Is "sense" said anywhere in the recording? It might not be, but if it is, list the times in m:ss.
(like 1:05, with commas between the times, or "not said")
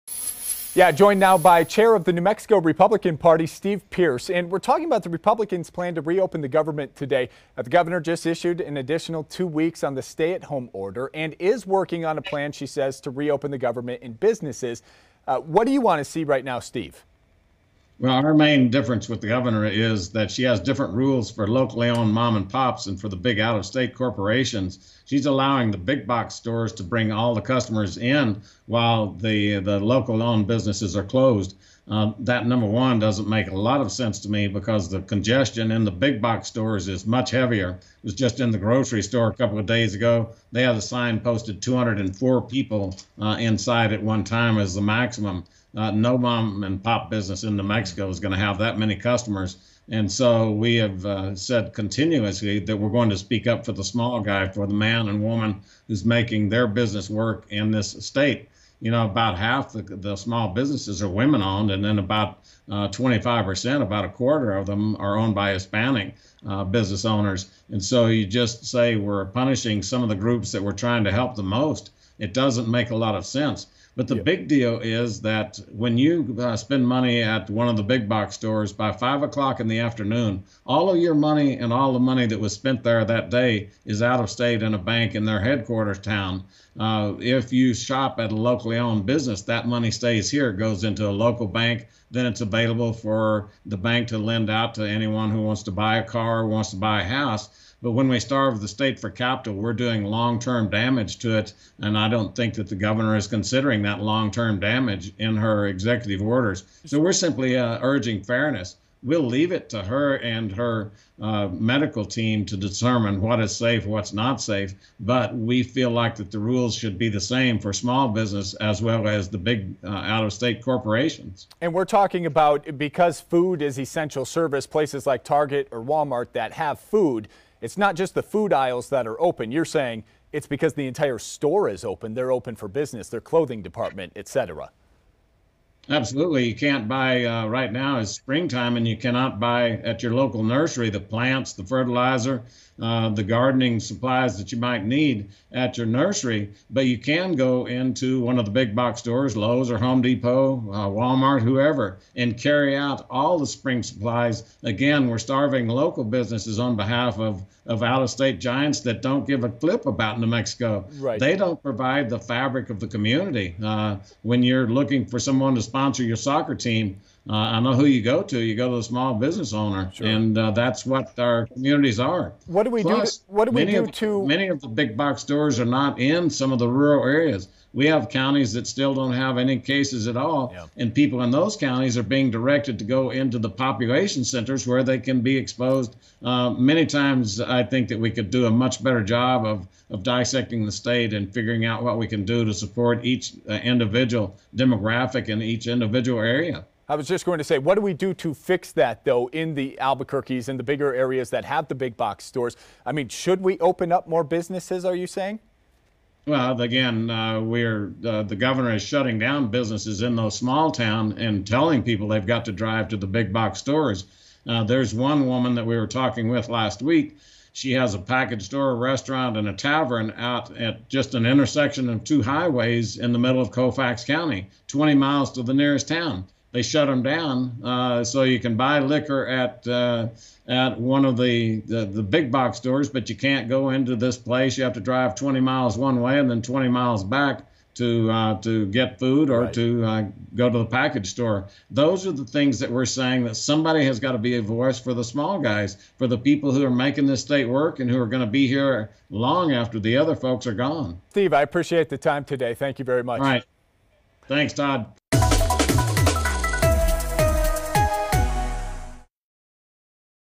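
0:33, 1:13.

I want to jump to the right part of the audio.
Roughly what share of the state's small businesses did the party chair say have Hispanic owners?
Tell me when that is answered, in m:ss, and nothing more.
1:02.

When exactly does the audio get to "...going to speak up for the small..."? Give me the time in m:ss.
0:52.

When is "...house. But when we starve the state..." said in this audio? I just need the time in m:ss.
1:37.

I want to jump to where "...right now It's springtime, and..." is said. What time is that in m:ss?
2:17.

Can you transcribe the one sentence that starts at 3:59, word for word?
to uh, go to the package store.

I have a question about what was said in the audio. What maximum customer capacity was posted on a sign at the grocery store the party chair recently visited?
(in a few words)
204 people.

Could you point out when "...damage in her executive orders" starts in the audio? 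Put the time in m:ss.
1:44.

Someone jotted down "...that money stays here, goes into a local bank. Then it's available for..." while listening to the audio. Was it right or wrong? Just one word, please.
right.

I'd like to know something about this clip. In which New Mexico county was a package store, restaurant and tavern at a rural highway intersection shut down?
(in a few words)
Colfax County.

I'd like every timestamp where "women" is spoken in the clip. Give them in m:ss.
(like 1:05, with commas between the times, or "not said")
1:01.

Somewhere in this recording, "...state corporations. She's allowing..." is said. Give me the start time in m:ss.
0:23.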